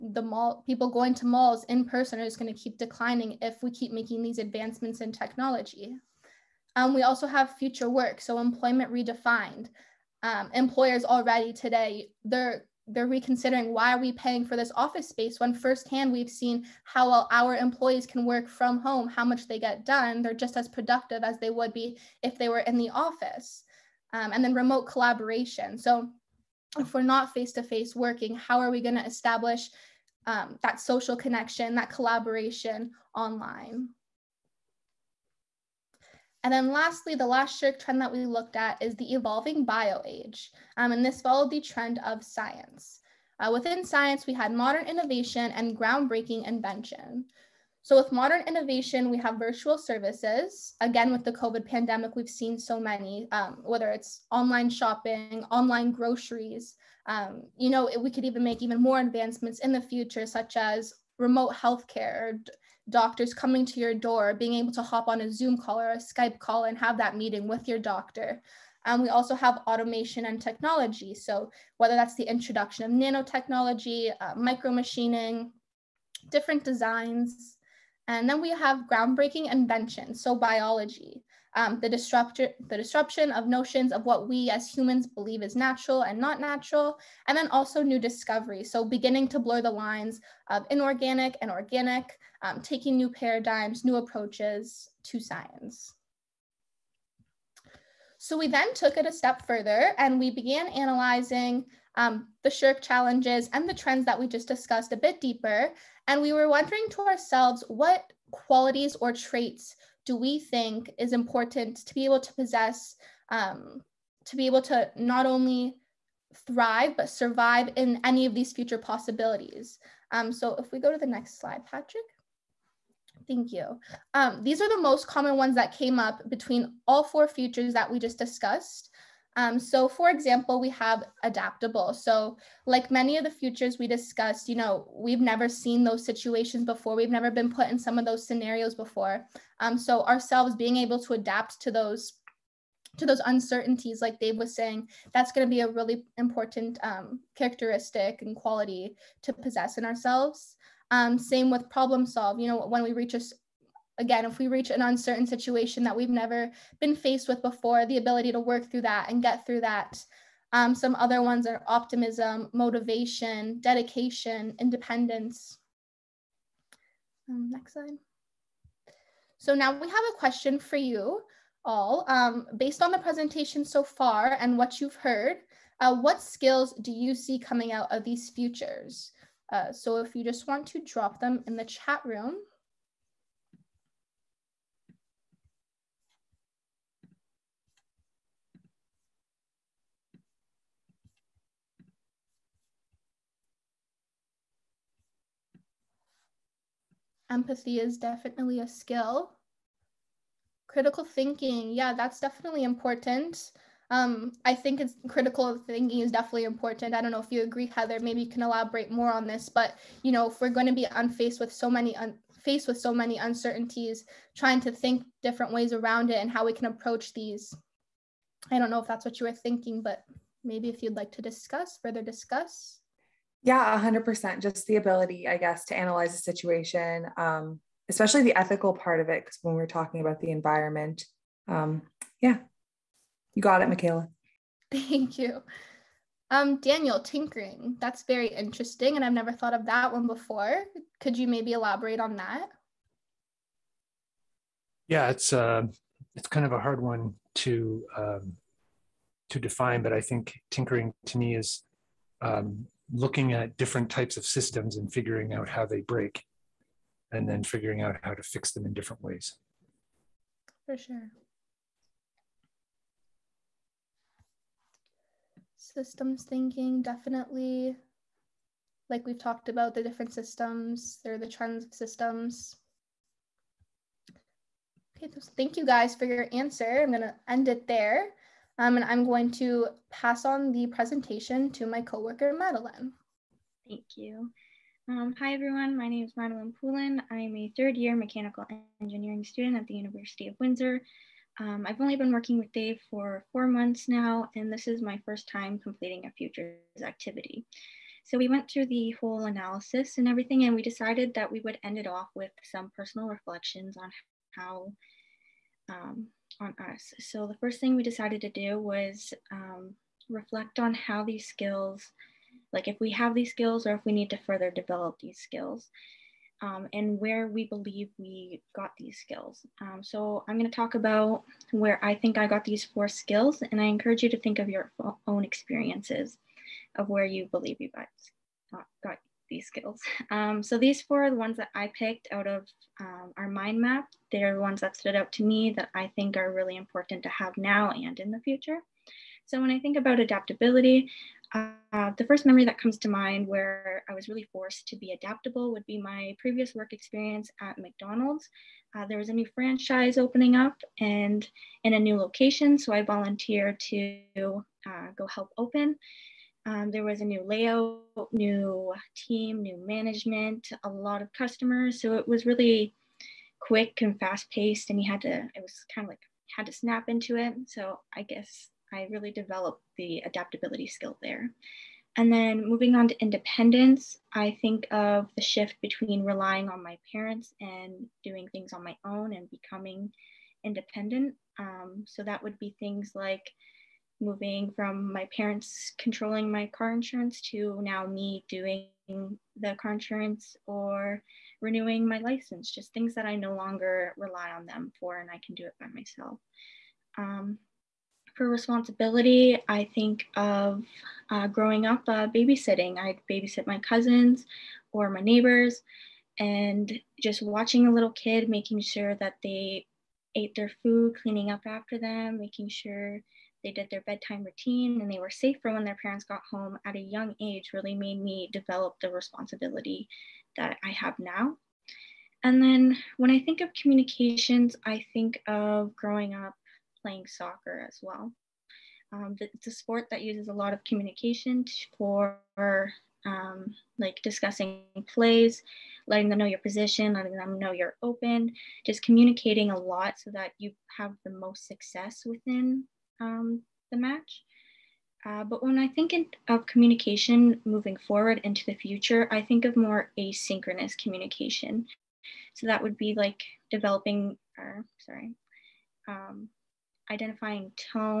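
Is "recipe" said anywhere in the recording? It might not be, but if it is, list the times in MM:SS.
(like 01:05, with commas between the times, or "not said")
not said.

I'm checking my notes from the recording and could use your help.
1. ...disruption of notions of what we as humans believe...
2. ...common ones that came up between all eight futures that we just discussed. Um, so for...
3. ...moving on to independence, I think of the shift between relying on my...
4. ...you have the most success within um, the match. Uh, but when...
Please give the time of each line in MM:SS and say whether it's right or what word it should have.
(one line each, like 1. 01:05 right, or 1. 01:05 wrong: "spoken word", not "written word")
1. 01:22 right
2. 02:05 wrong: "four", not "eight"
3. 06:12 right
4. 07:20 right.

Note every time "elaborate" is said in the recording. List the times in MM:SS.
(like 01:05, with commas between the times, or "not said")
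03:28, 04:01.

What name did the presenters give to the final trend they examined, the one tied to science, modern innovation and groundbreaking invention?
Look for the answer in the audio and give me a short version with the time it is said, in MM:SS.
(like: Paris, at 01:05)
evolving bio age, at 00:39.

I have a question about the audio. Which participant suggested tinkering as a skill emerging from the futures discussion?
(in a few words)
Daniel.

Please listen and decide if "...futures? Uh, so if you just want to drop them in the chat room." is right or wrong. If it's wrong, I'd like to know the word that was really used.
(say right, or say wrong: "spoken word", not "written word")
right.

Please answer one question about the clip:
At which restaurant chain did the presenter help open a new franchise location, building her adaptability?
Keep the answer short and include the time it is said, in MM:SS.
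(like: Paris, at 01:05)
McDonald's, at 05:47.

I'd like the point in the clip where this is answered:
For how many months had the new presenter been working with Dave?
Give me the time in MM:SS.
04:53.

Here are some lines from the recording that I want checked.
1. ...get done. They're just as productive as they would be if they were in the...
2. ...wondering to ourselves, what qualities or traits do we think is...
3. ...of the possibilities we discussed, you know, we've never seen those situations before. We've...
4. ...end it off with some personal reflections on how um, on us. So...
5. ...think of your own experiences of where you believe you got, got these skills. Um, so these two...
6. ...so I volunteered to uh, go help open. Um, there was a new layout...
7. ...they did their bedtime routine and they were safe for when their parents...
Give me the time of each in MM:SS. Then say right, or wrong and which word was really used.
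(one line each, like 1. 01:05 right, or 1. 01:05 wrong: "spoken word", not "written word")
1. 00:19 right
2. 01:46 right
3. 02:13 wrong: "futures", not "possibilities"
4. 05:01 right
5. 05:24 wrong: "four", not "two"
6. 05:52 right
7. 06:53 right.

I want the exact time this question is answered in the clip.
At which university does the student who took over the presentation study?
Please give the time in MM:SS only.
04:49.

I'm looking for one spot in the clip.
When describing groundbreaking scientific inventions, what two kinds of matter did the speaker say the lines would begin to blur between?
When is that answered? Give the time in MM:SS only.
01:30.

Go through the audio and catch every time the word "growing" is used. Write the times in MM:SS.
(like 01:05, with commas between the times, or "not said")
06:41, 07:05.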